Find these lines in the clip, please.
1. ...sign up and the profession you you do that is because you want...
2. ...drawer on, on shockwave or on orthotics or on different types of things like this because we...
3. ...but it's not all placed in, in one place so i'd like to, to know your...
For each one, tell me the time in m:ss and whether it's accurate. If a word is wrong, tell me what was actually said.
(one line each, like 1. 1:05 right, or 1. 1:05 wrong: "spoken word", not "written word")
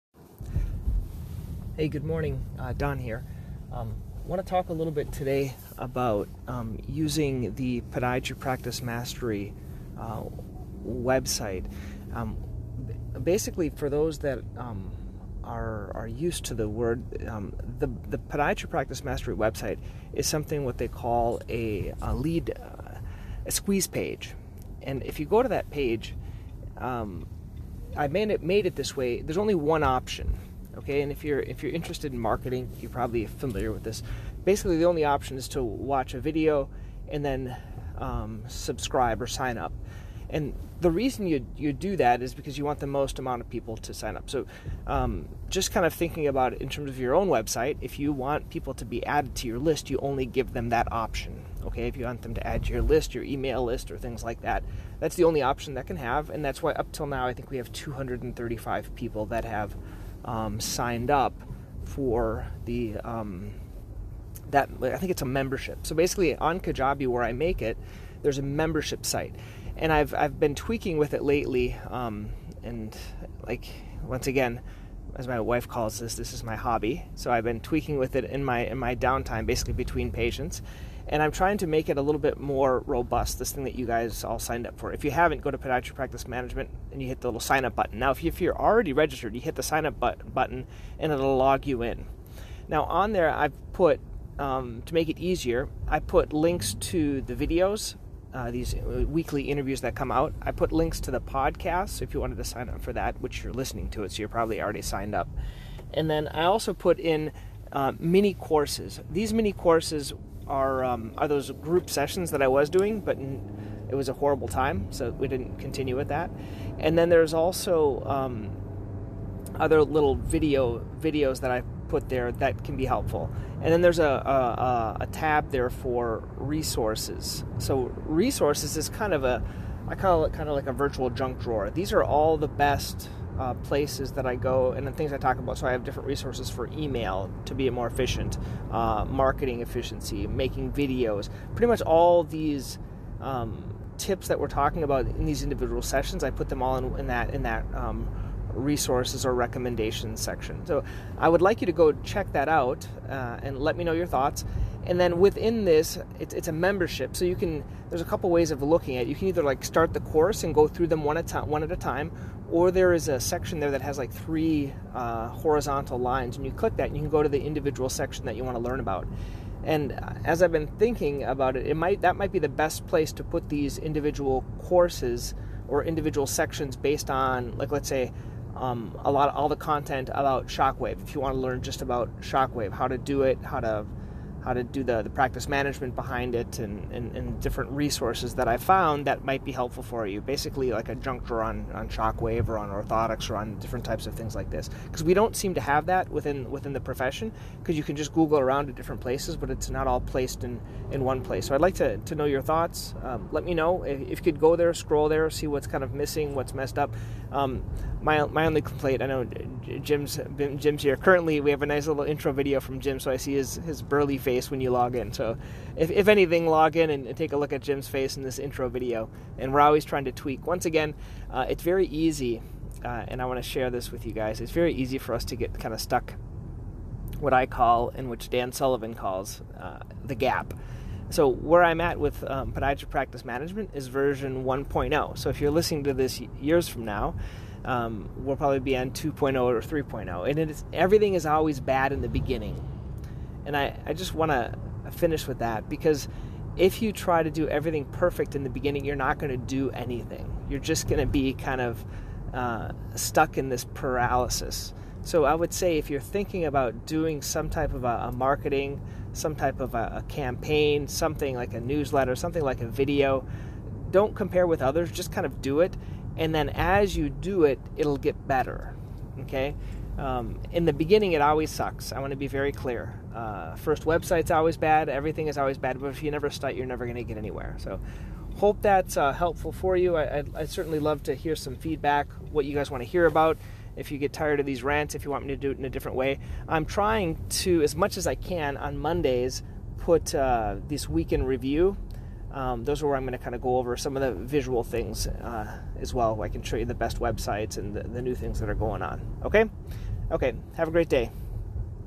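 1. 0:39 wrong: "reason", not "profession"
2. 3:11 right
3. 3:19 right.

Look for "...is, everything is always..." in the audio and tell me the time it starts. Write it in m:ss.
4:00.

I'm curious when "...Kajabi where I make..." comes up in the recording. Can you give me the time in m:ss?
1:06.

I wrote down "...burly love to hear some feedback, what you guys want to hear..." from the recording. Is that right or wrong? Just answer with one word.
wrong.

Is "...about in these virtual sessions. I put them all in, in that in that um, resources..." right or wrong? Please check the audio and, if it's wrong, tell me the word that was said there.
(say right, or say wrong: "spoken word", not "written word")
wrong: "individual", not "virtual".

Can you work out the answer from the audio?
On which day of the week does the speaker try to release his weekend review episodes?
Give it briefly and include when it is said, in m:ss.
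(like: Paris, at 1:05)
Mondays, at 4:48.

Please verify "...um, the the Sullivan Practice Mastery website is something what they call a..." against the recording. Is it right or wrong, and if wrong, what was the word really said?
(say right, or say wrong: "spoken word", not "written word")
wrong: "Podiatry", not "Sullivan".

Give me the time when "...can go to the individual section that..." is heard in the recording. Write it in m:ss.
2:47.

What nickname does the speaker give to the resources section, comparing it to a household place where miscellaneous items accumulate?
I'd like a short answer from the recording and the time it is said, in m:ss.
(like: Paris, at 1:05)
virtual junk drawer, at 2:10.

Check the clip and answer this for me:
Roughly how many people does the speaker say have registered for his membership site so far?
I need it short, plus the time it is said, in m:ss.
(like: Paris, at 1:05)
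235, at 0:57.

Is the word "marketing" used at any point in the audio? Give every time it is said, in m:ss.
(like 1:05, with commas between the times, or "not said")
0:32, 2:19, 4:18.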